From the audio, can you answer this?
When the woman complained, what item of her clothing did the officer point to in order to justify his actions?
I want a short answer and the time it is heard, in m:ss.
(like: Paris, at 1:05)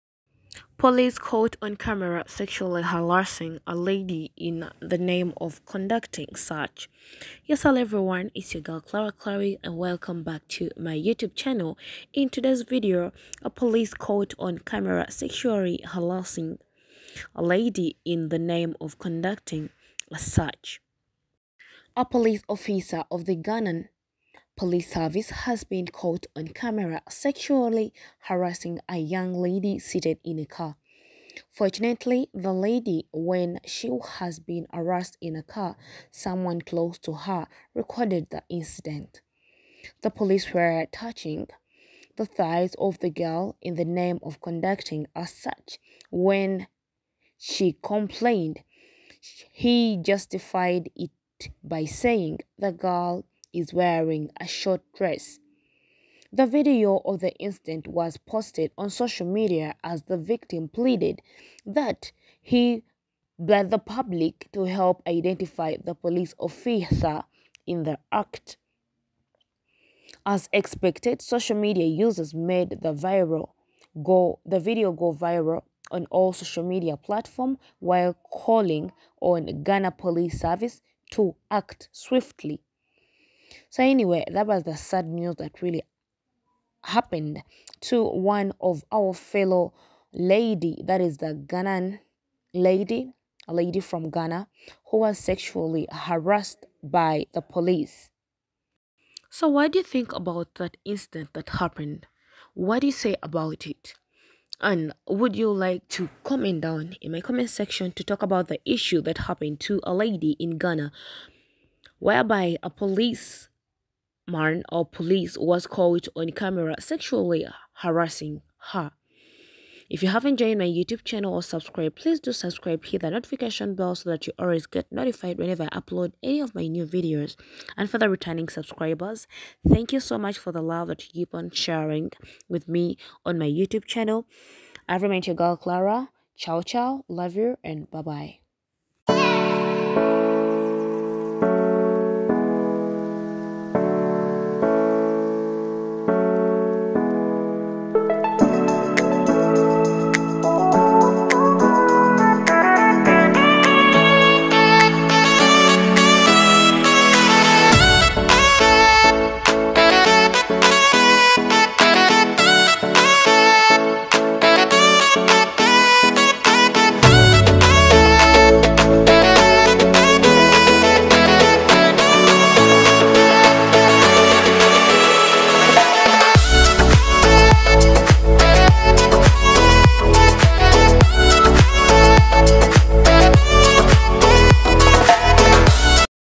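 short dress, at 0:54.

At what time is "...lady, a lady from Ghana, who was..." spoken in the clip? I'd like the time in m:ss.
1:32.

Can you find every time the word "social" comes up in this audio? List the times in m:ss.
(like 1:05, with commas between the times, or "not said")
0:58, 1:11, 1:16.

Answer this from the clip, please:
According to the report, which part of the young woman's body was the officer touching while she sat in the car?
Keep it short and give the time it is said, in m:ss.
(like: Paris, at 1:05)
thighs, at 0:42.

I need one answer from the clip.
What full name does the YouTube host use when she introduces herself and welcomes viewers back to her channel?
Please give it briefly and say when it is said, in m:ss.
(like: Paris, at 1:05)
Clara Clare, at 0:08.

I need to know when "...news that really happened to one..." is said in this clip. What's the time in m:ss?
1:25.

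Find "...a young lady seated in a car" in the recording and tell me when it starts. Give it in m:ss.
0:28.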